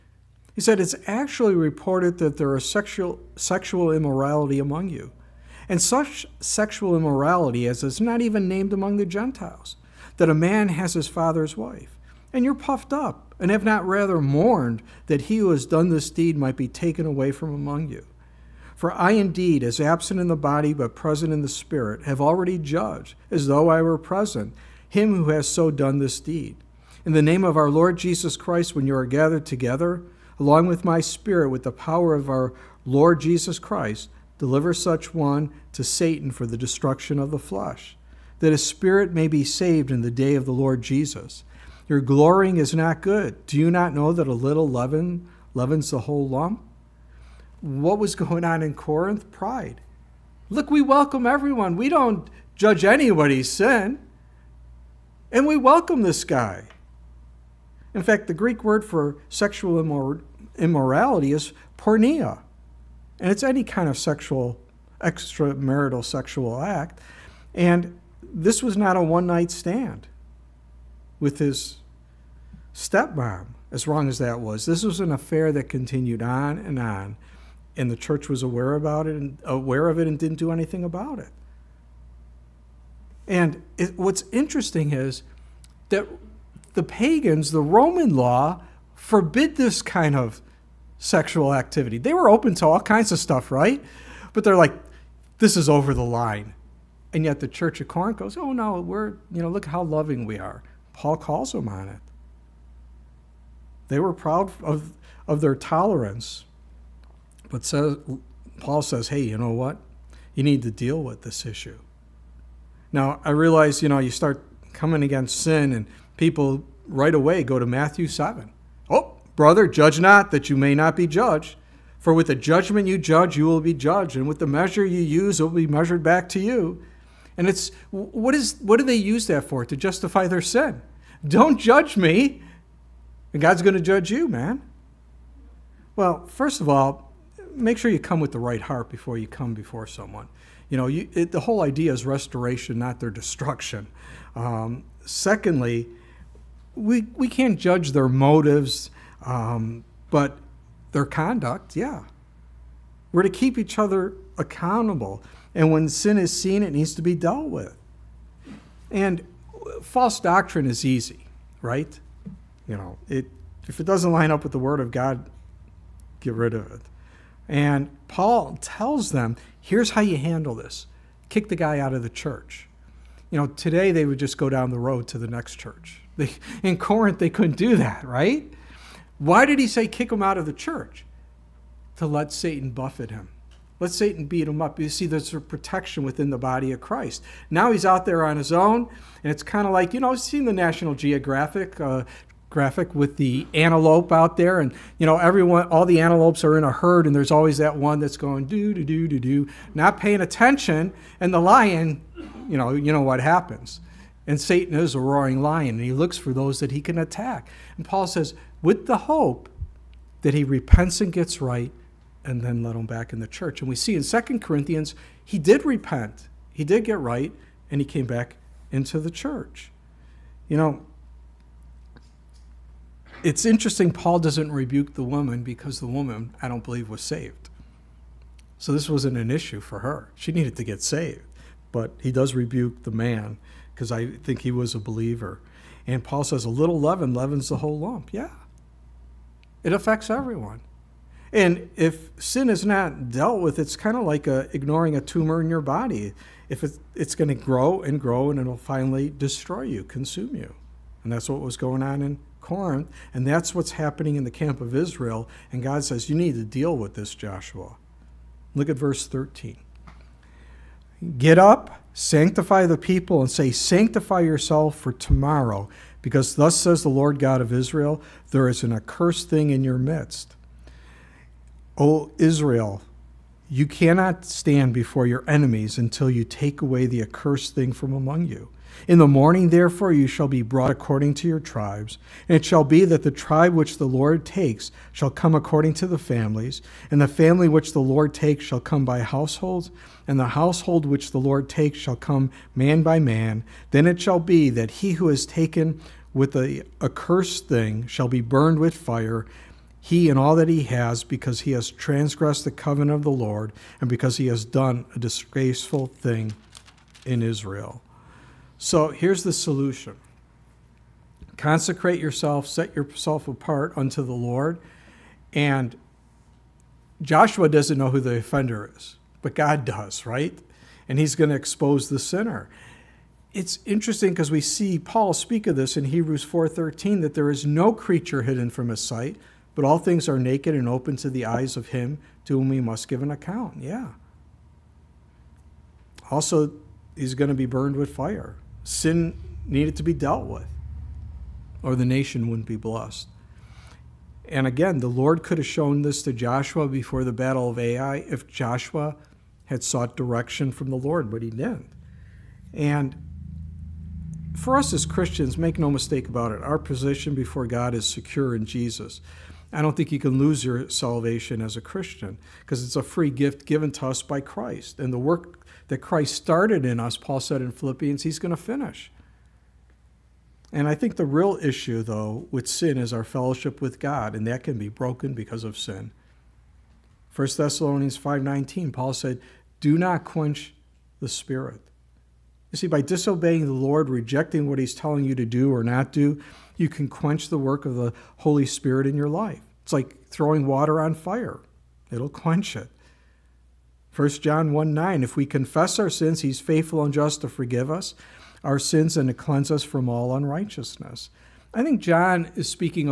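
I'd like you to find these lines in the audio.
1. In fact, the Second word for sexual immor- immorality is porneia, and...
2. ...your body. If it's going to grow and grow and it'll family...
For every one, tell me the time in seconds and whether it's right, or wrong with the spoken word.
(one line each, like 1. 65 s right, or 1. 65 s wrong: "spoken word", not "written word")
1. 57 s wrong: "Greek", not "Second"
2. 245 s wrong: "finally", not "family".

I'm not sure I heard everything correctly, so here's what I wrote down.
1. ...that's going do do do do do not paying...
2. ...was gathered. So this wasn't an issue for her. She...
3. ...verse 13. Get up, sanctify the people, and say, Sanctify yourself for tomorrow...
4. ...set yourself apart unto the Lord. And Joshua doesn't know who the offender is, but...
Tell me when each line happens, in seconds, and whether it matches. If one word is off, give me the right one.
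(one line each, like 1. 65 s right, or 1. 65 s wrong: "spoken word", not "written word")
1. 198 s right
2. 226 s wrong: "saved", not "gathered"
3. 258 s right
4. 312 s right.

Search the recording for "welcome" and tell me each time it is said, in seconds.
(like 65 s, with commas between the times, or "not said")
50 s, 55 s.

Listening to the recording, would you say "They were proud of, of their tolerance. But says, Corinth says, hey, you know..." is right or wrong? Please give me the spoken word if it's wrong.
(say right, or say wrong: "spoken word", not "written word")
wrong: "Paul", not "Corinth".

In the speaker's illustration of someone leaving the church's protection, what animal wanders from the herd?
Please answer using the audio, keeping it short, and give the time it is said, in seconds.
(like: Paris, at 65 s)
antelope, at 193 s.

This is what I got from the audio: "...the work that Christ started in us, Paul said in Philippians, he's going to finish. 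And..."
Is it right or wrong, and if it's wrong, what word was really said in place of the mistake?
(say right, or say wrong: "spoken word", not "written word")
right.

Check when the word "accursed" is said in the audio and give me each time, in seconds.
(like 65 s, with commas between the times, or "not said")
268 s, 277 s, 296 s.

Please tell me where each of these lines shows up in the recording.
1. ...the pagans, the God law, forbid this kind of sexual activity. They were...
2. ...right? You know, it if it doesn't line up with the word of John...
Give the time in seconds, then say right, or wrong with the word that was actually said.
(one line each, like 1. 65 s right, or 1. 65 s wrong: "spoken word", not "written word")
1. 86 s wrong: "Roman", not "God"
2. 161 s wrong: "God", not "John".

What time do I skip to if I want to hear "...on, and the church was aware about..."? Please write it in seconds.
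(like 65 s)
76 s.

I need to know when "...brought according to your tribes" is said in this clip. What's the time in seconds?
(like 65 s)
280 s.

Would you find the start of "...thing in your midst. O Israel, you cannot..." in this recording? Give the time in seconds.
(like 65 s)
269 s.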